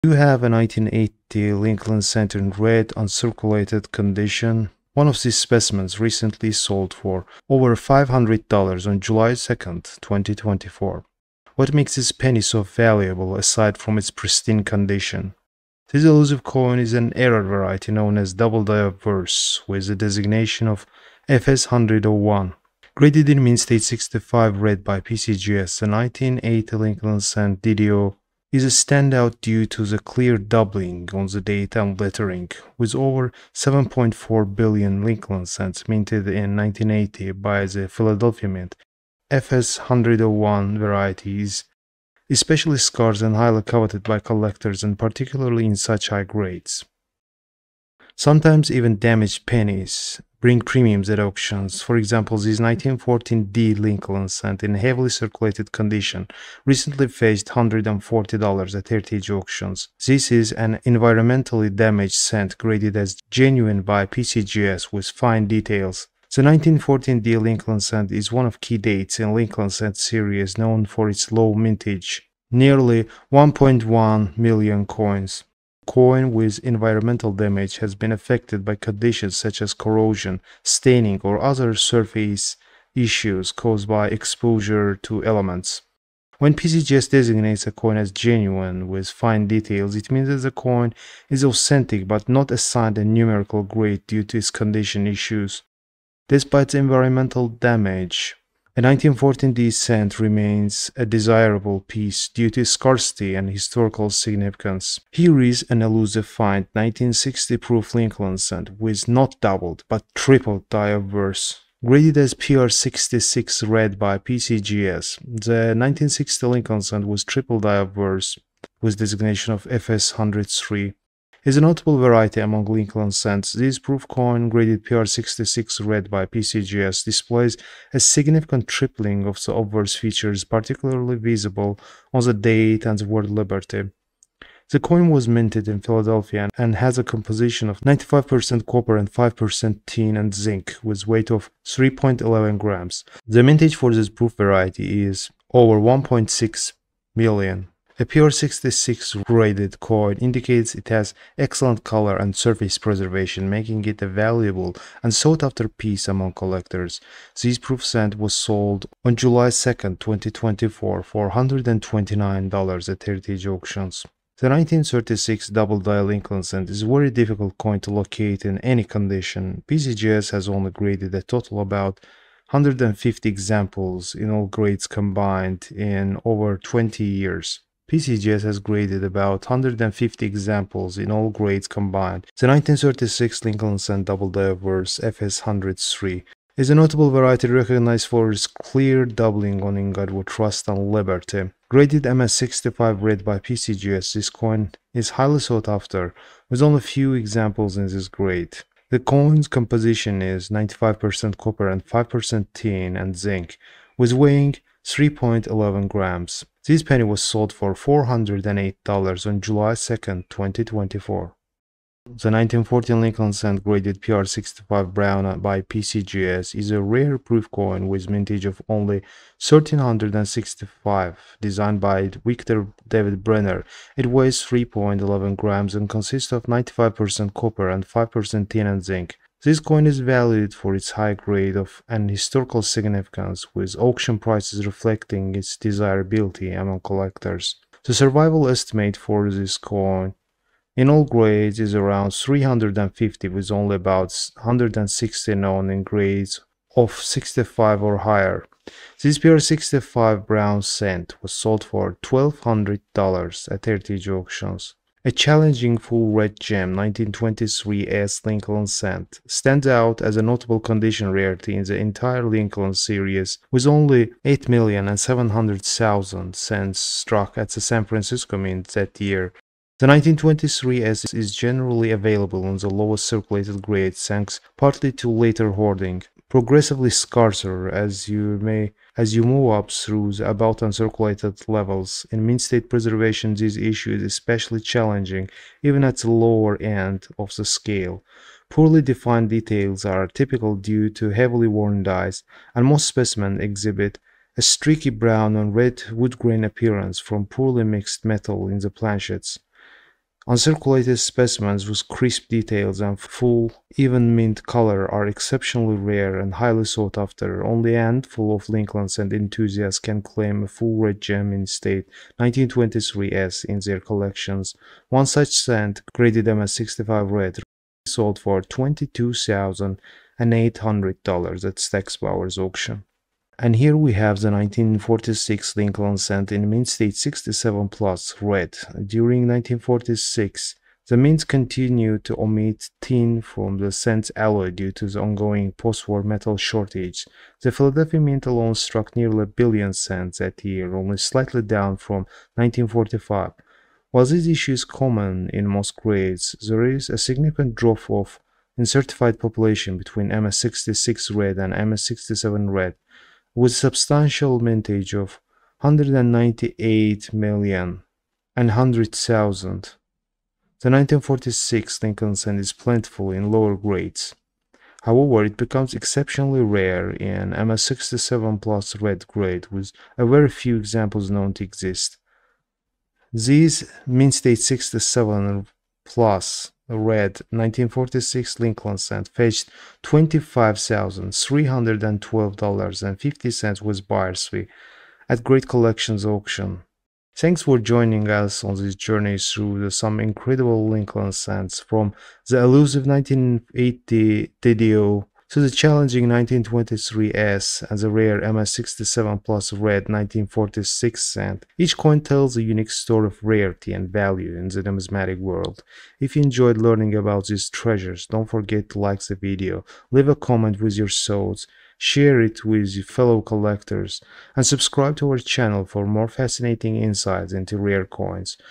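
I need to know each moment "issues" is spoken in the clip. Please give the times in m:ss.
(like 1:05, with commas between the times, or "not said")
1:22, 1:35, 4:43, 5:44.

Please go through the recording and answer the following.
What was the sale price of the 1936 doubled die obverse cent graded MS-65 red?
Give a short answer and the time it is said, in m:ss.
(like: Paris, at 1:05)
$408, at 3:27.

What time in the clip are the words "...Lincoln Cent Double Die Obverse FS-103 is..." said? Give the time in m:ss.
3:03.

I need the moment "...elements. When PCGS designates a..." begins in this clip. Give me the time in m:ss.
1:25.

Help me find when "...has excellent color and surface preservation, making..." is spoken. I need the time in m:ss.
2:30.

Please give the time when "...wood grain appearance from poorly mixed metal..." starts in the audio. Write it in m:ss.
4:55.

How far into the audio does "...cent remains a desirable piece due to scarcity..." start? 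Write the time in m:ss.
1:39.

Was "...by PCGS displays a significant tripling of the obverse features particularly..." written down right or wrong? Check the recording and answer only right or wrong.
right.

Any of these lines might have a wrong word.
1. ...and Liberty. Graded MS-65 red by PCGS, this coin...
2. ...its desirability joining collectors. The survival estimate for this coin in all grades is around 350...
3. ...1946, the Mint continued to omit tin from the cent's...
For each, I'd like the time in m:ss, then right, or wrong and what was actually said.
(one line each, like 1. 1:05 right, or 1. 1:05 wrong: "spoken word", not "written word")
1. 3:10 right
2. 3:55 wrong: "among", not "joining"
3. 5:29 right.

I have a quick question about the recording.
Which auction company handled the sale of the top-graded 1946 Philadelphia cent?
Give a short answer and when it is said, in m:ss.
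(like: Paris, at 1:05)
Great Collections, at 6:25.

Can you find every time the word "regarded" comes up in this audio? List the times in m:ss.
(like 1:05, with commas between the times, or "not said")
not said.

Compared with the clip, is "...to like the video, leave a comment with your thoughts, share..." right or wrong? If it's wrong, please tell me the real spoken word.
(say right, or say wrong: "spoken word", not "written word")
right.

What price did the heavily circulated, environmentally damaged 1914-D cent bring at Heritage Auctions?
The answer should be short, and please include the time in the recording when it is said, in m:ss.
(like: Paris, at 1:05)
$140, at 0:57.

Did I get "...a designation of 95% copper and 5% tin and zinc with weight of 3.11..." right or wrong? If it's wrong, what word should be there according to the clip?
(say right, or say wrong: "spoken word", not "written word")
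wrong: "composition", not "designation".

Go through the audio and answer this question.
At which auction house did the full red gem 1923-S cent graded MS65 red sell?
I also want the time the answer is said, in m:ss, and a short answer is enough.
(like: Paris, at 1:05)
Stack's Bowers, at 5:21.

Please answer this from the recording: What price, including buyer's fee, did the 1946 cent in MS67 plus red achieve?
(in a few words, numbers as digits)
$25,312.50.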